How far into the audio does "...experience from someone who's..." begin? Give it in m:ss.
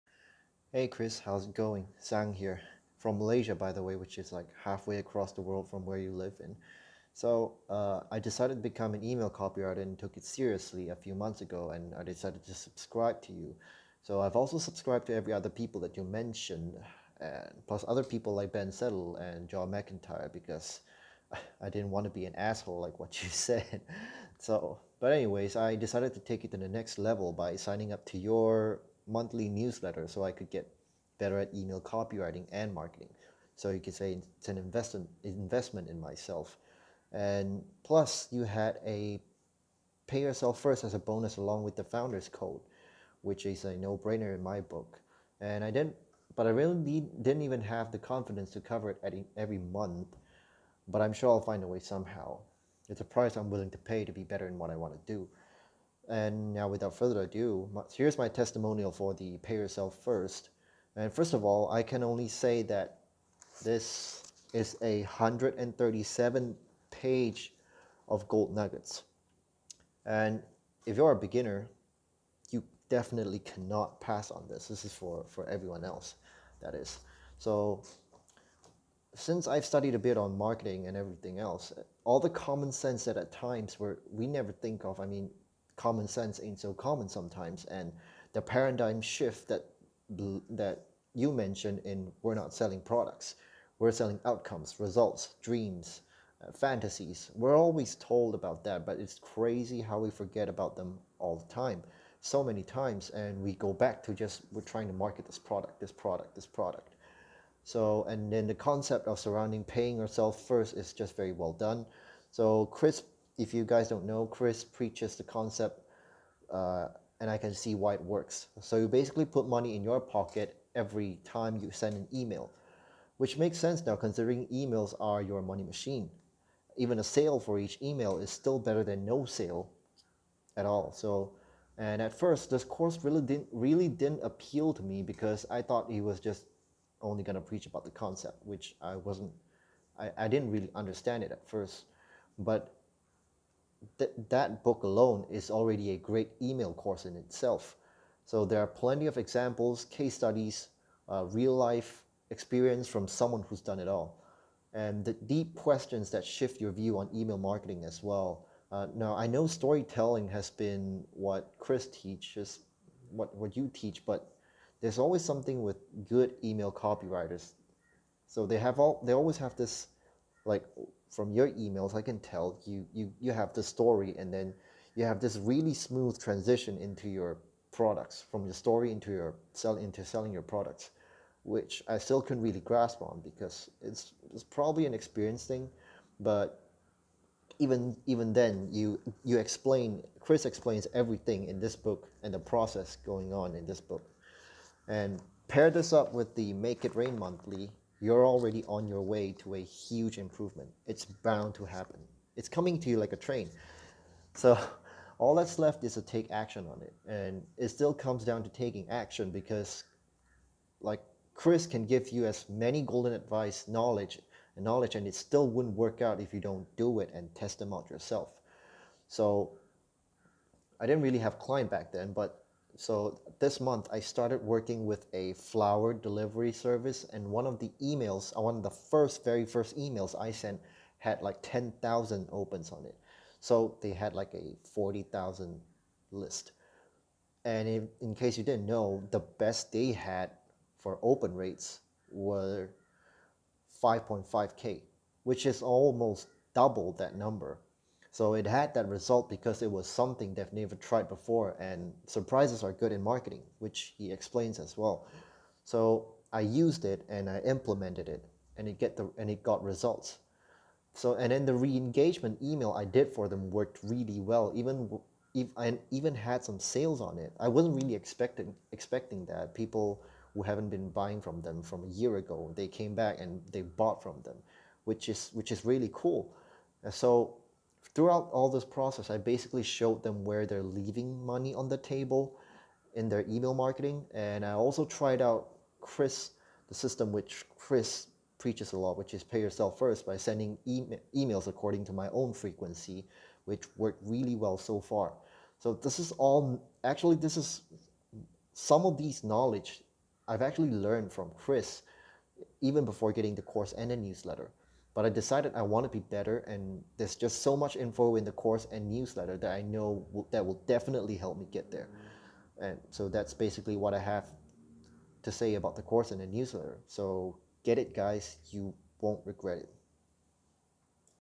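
2:32.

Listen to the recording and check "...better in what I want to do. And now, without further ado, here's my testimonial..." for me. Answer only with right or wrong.
right.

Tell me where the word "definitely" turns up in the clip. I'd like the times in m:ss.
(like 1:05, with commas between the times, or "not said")
1:12, 5:10.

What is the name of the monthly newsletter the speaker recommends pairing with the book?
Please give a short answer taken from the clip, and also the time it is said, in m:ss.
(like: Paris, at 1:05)
Make It Rain, at 3:16.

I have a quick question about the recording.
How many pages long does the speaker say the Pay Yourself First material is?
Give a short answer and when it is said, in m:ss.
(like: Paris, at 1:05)
137, at 1:05.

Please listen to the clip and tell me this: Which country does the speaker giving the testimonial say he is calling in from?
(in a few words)
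Malaysia.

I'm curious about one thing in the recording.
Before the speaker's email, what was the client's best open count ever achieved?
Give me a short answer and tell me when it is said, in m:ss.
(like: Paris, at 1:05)
5.5K, at 4:03.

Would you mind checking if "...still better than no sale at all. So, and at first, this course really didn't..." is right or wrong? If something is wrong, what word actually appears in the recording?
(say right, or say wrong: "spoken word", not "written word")
right.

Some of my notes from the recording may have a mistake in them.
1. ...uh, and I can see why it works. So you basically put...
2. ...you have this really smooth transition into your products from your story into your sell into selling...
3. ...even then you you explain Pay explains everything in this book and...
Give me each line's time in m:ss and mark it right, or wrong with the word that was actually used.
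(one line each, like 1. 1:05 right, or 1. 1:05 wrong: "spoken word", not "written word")
1. 1:56 right
2. 2:54 right
3. 3:08 wrong: "Chris", not "Pay".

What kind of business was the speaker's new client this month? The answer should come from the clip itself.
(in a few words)
flower delivery service.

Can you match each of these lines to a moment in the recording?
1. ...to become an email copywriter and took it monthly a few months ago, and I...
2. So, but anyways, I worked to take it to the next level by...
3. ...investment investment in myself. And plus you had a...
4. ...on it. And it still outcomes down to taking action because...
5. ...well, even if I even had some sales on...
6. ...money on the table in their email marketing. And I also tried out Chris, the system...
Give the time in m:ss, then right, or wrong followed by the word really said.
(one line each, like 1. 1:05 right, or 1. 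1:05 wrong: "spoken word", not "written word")
1. 0:08 wrong: "seriously", not "monthly"
2. 0:24 wrong: "decided", not "worked"
3. 0:34 right
4. 3:26 wrong: "comes", not "outcomes"
5. 4:24 right
6. 4:41 right.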